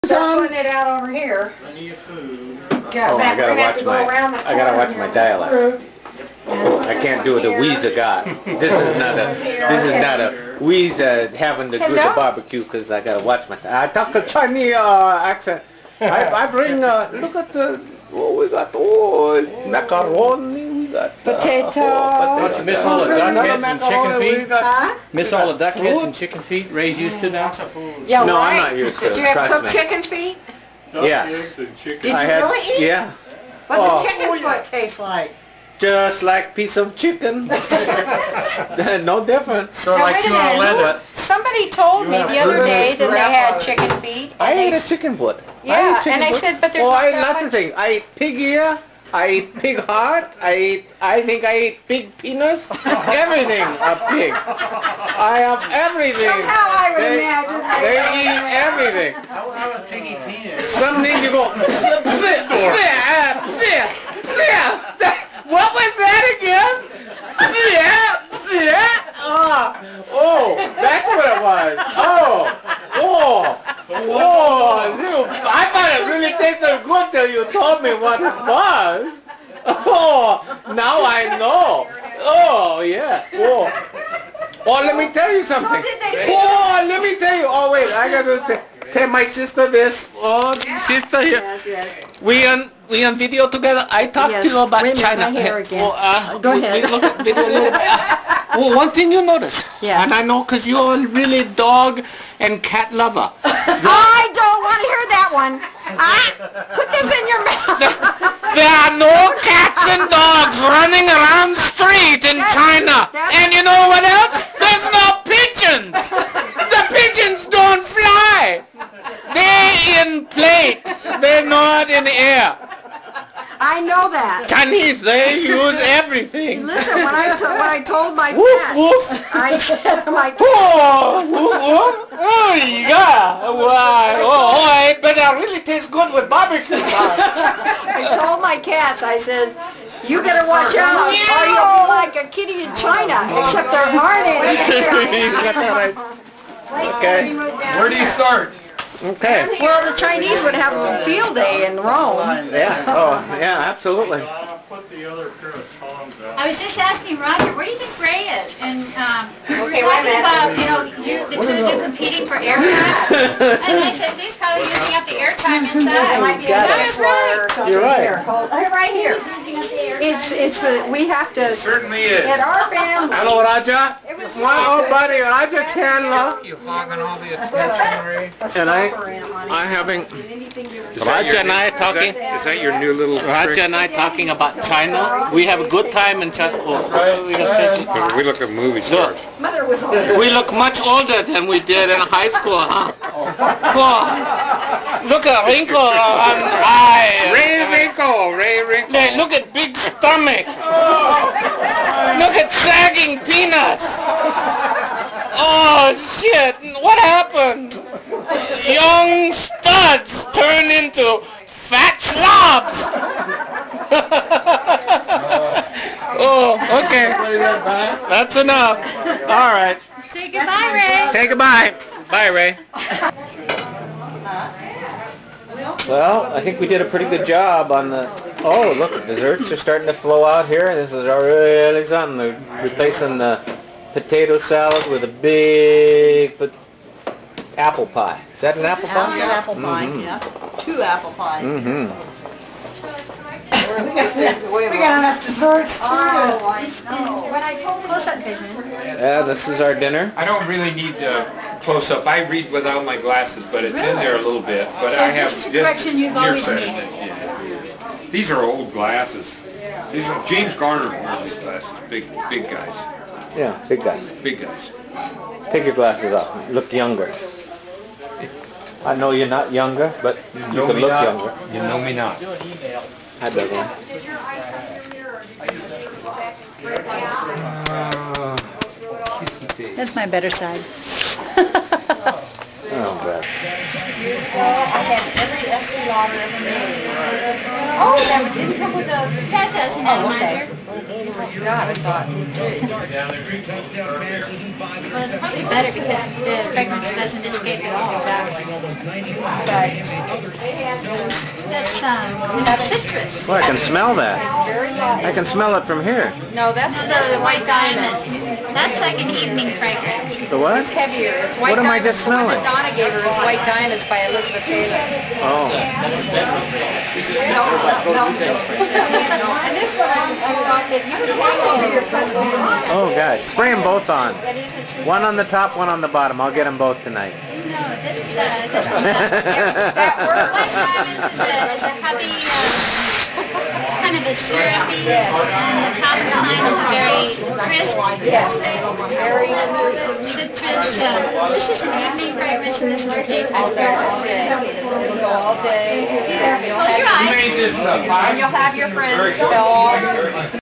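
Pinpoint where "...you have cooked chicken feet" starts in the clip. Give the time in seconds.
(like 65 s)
29 s.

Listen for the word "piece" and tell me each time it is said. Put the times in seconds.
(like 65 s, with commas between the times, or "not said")
36 s.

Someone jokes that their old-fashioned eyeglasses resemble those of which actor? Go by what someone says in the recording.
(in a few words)
James Garner.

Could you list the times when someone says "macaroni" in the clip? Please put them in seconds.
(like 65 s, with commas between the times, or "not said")
19 s.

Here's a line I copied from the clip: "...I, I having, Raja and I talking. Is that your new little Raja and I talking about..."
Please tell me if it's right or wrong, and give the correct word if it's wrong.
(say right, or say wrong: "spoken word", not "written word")
right.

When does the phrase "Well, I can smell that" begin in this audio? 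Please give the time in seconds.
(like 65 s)
303 s.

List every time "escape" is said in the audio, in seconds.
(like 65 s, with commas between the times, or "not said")
297 s.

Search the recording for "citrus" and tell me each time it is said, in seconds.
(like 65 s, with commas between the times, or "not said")
302 s, 340 s.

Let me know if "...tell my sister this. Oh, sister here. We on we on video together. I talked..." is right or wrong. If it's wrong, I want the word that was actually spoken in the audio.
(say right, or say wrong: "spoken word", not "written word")
right.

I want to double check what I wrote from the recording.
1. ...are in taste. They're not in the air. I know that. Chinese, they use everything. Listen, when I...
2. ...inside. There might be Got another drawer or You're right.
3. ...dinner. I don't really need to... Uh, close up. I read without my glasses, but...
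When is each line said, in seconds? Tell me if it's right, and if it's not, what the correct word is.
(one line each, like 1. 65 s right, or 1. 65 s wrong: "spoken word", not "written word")
1. 119 s wrong: "plate", not "taste"
2. 165 s right
3. 249 s right.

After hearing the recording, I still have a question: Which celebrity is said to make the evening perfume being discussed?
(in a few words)
Elizabeth Taylor.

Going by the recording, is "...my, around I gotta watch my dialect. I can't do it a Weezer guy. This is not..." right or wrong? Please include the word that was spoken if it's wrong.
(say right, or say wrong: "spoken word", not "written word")
right.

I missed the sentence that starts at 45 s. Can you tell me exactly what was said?
Yeah, I and I said, but there's oh, not I that much.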